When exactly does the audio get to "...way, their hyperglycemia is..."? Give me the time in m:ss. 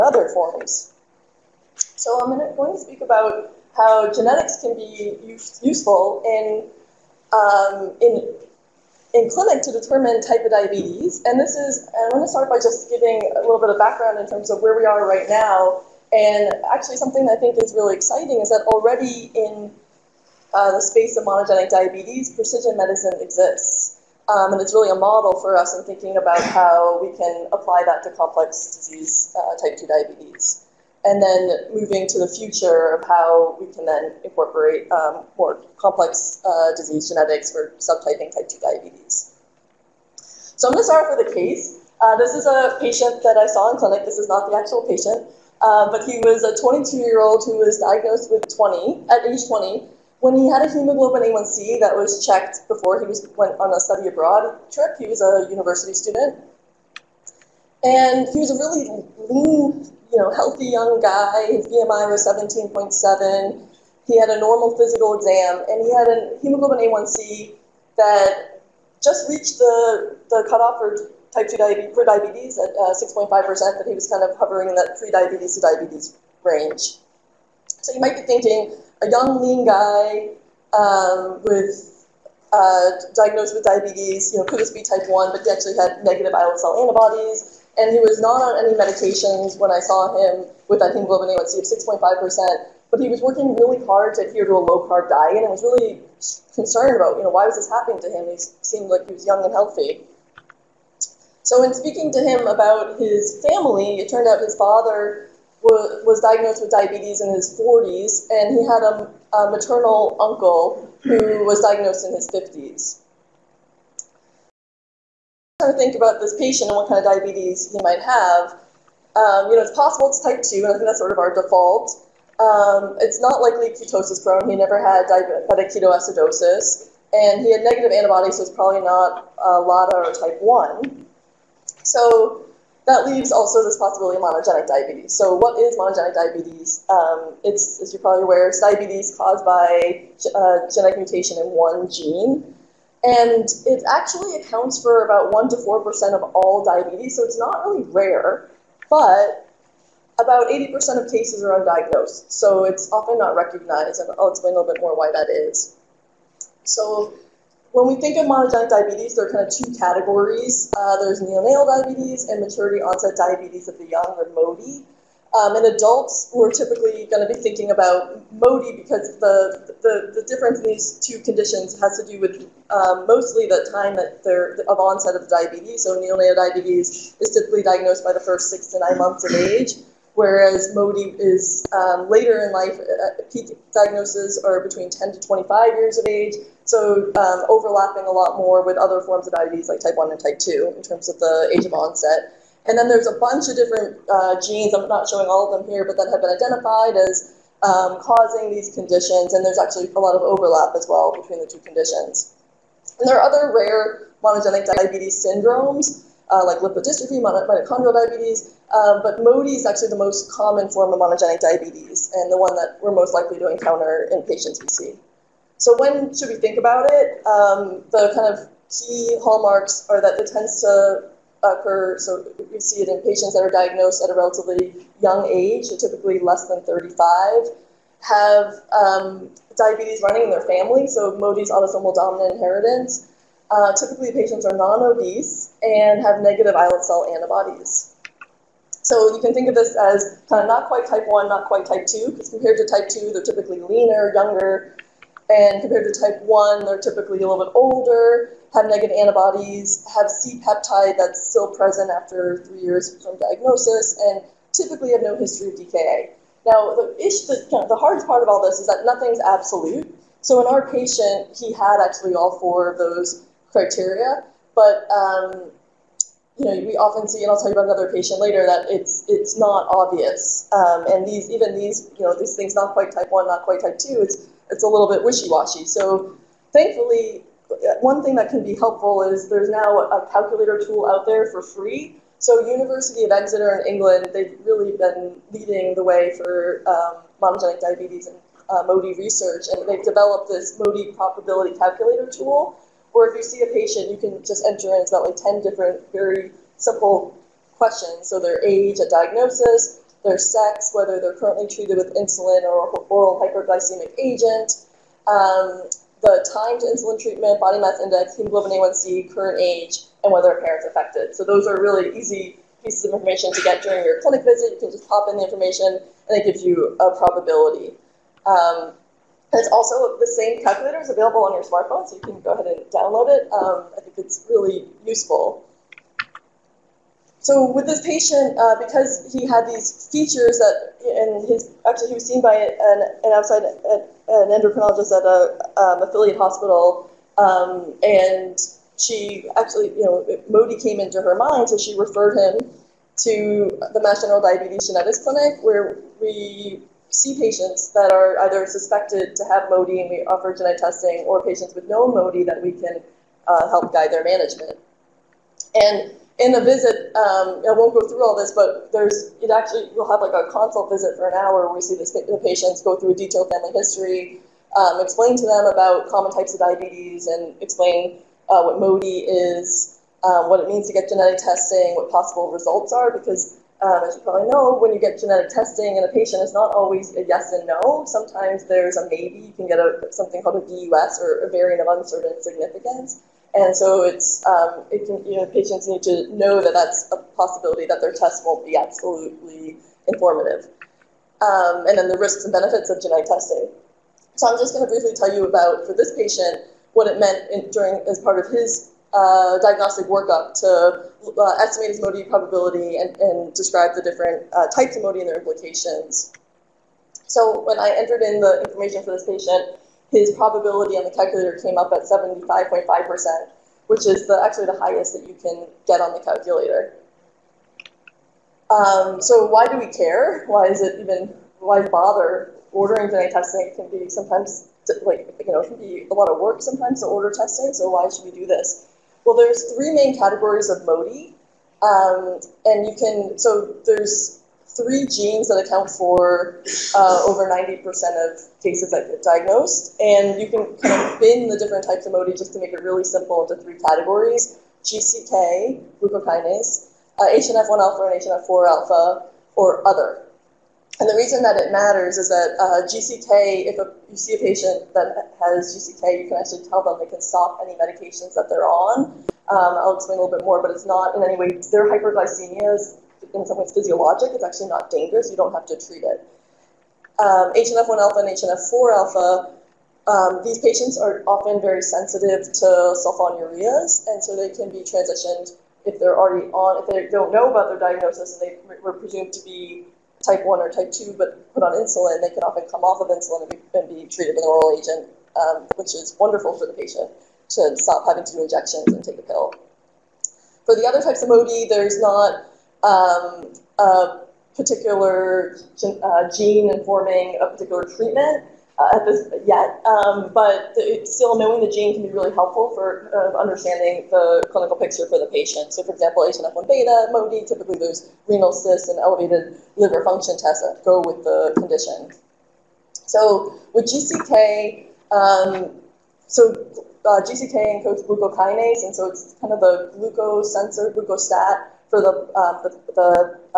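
7:41.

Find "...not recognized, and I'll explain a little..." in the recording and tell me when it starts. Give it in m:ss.
2:33.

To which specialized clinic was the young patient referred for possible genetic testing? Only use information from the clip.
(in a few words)
Mass General Diabetes Genetics Clinic.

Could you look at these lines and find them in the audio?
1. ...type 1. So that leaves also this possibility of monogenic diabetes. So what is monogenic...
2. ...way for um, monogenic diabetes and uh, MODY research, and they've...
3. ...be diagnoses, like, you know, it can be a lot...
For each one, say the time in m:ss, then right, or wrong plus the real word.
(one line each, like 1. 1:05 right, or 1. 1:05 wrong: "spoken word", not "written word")
1. 2:10 right
2. 4:45 right
3. 7:03 wrong: "sometimes", not "diagnoses".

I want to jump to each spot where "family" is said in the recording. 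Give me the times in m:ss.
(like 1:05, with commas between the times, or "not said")
1:43, 3:50, 6:03.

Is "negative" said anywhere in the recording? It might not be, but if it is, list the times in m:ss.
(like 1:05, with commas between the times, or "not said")
1:26, 2:07, 3:56, 4:08.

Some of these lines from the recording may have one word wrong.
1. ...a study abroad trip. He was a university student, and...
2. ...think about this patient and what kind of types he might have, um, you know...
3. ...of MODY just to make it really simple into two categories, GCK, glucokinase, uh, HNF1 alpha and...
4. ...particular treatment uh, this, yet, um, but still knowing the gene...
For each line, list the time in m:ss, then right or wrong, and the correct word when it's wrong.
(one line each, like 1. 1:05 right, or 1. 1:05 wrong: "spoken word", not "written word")
1. 0:53 right
2. 1:55 wrong: "diabetes", not "types"
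3. 7:21 wrong: "three", not "two"
4. 8:17 right.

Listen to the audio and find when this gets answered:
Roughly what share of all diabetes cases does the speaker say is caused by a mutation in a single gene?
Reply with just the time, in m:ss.
2:25.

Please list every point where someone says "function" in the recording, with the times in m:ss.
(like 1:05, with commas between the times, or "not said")
8:29.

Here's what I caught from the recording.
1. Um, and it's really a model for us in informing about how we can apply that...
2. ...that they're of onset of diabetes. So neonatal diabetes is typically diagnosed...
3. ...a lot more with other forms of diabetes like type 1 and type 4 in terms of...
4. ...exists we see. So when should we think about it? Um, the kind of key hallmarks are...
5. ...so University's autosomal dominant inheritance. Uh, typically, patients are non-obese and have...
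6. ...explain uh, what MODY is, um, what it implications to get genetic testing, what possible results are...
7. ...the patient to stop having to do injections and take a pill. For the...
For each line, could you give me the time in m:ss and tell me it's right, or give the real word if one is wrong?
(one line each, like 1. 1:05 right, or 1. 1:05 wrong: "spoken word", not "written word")
1. 0:24 wrong: "thinking", not "informing"
2. 2:53 right
3. 3:08 wrong: "2", not "4"
4. 3:34 wrong: "patients", not "exists"
5. 3:50 wrong: "MODY", not "University"
6. 6:07 wrong: "means", not "implications"
7. 8:06 right.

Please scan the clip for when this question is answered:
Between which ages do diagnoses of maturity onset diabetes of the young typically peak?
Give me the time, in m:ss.
3:04.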